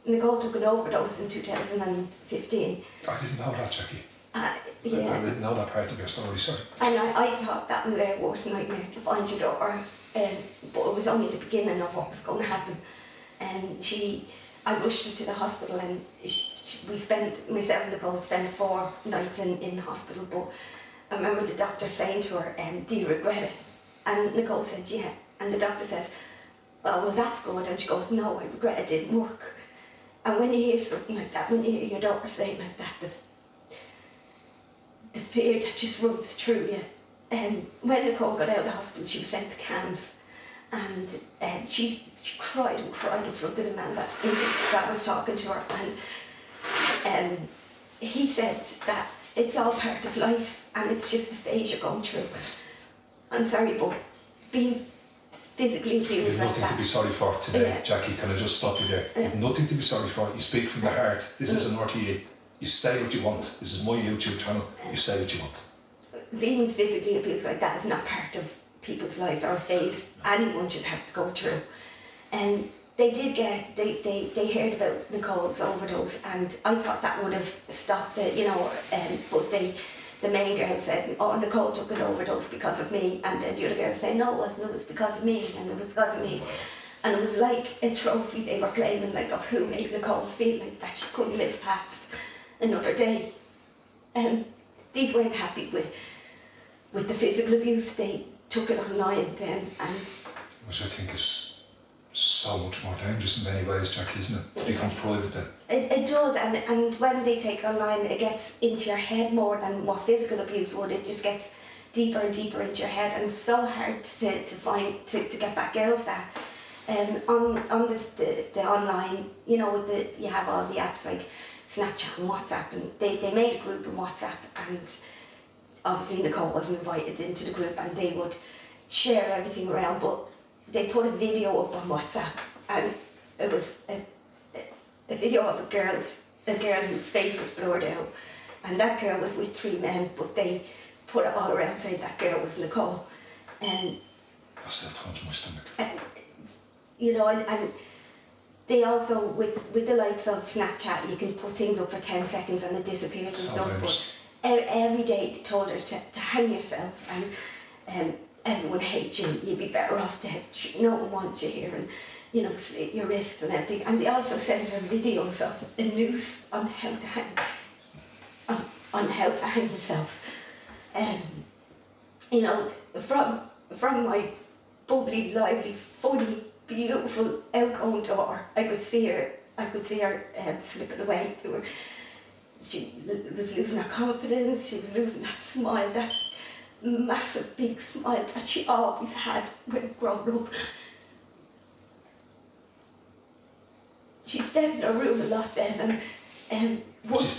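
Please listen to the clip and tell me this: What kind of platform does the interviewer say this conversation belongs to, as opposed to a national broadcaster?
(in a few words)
YouTube channel.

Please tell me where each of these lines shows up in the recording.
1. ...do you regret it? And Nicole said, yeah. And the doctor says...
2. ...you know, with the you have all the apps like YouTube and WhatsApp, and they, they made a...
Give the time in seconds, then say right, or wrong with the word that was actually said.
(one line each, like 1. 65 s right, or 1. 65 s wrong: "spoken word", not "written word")
1. 22 s right
2. 119 s wrong: "Snapchat", not "YouTube".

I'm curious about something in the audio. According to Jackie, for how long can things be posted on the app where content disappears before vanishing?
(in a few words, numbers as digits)
10 seconds.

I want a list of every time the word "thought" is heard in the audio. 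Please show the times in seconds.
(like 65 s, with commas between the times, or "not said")
7 s, 76 s.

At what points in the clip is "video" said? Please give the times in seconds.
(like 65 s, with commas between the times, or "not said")
131 s, 135 s, 164 s.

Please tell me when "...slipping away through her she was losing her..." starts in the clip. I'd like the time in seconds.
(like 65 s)
180 s.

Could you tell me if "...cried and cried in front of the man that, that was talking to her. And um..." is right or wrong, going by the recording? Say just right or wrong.
right.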